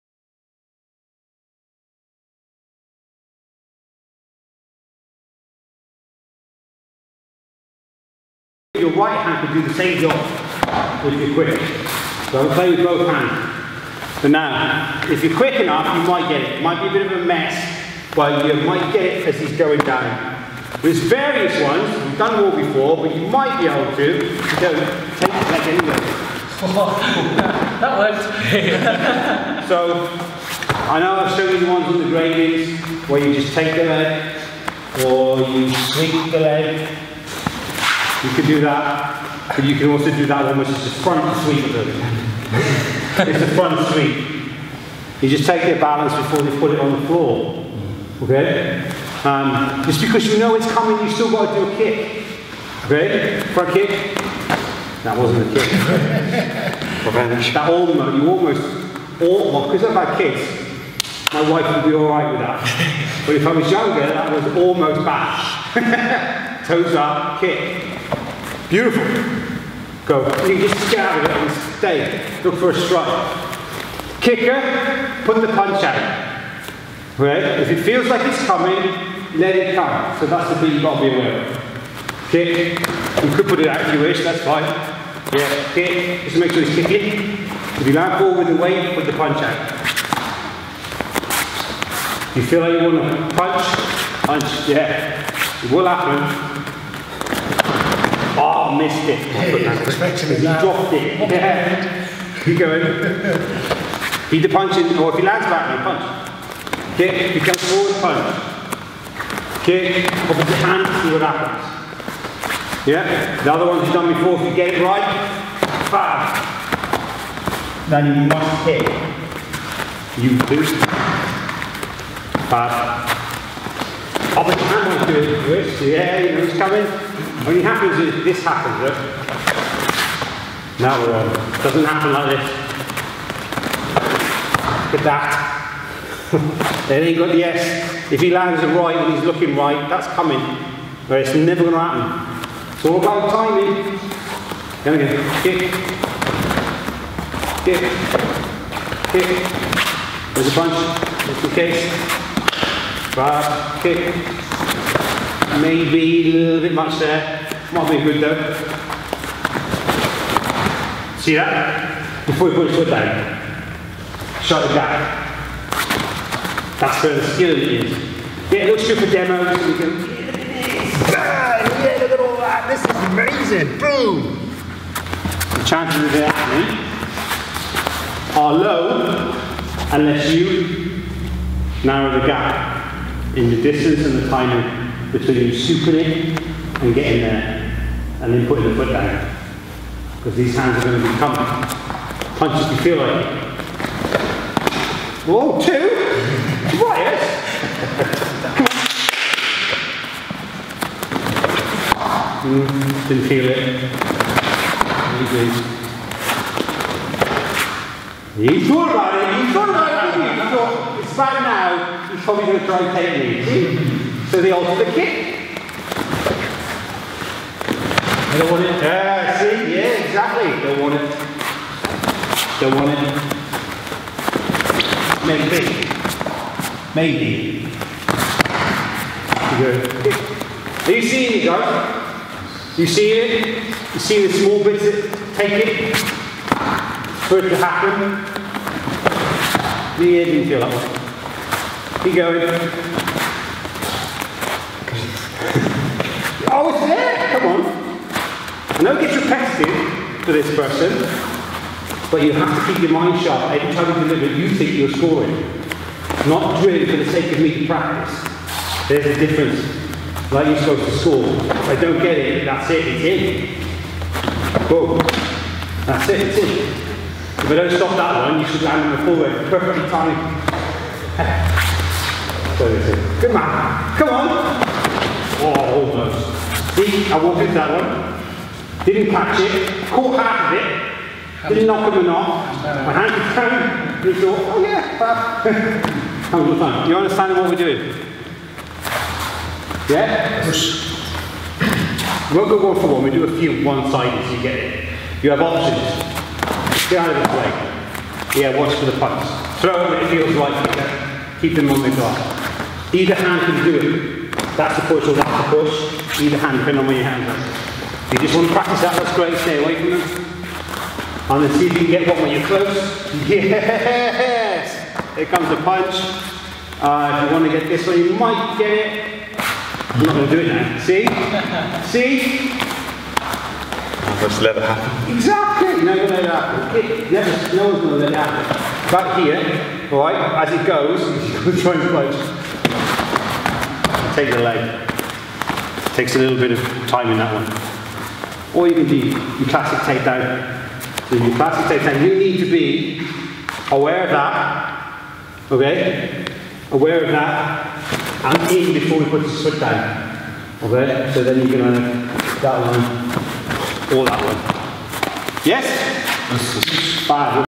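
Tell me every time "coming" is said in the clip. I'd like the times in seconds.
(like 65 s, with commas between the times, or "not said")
50 s, 78 s, 126 s, 140 s.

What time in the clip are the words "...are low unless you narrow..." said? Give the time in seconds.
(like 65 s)
178 s.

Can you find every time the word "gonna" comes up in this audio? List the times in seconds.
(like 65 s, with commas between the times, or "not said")
141 s, 351 s.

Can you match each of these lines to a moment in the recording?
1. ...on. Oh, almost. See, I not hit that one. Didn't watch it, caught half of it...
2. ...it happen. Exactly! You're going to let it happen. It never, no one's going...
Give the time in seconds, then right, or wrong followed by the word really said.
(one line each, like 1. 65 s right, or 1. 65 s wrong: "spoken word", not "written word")
1. 274 s wrong: "catch", not "watch"
2. 324 s right.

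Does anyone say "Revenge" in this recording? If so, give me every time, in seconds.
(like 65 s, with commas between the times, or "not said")
57 s.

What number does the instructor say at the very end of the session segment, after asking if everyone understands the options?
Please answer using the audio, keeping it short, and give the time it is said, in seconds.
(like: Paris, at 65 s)
5, at 357 s.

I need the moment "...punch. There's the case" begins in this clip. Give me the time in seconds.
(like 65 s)
150 s.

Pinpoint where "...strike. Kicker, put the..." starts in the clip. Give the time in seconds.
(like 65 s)
72 s.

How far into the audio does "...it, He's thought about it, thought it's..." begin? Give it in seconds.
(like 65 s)
209 s.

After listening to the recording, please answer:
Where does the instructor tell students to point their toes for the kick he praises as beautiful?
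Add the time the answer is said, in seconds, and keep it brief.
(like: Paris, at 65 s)
Toes up, at 66 s.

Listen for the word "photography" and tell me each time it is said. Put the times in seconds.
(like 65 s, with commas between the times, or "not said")
not said.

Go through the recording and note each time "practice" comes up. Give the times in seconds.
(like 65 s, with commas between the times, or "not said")
257 s, 308 s.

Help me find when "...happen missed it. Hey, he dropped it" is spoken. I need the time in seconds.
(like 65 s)
95 s.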